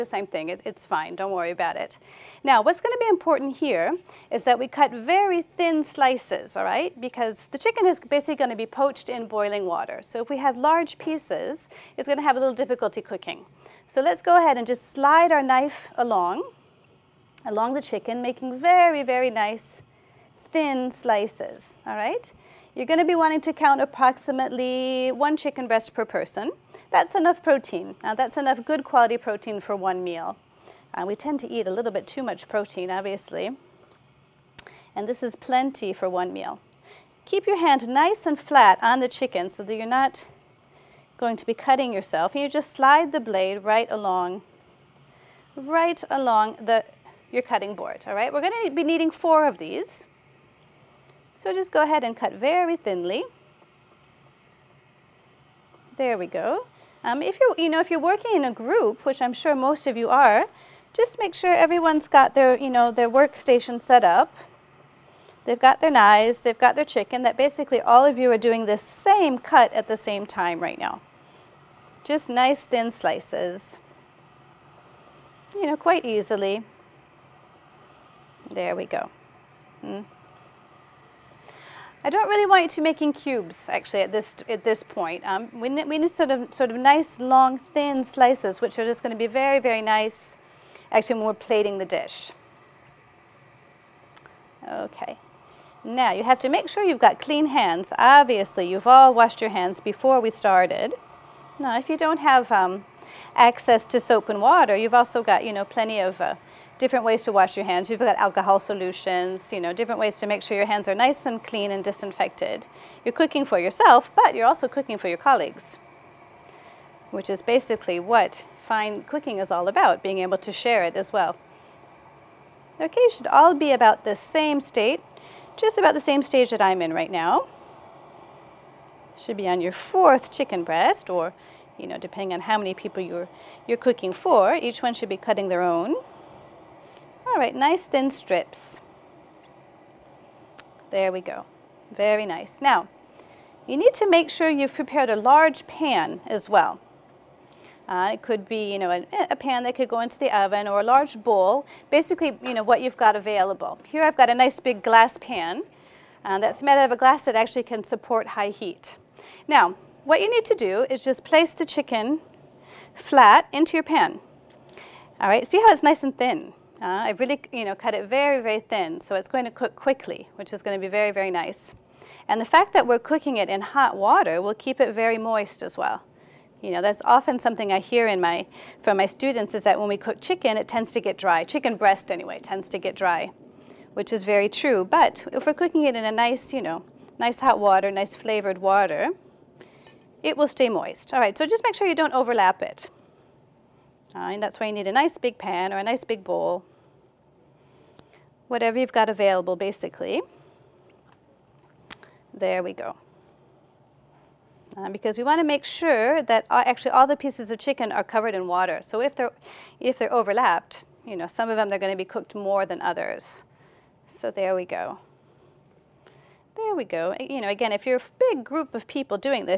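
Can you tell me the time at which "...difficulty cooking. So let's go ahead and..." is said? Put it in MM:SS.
00:12.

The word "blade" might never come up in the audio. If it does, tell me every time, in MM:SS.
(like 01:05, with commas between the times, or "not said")
00:43.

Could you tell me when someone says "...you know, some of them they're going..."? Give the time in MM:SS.
03:31.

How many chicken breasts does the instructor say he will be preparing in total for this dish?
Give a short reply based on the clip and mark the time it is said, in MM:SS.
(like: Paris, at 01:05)
4, at 00:49.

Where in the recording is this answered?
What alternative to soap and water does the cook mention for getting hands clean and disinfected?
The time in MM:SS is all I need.
01:48.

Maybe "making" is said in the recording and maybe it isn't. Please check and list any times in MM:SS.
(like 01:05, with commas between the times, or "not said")
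00:18, 01:22.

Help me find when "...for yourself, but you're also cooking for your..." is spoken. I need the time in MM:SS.
01:53.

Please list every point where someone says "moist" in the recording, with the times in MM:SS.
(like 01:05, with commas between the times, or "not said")
02:55, 03:10.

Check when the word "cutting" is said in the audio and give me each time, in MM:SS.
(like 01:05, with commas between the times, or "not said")
00:41, 00:47, 02:15.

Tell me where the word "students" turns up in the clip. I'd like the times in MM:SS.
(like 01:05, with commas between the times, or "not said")
02:59.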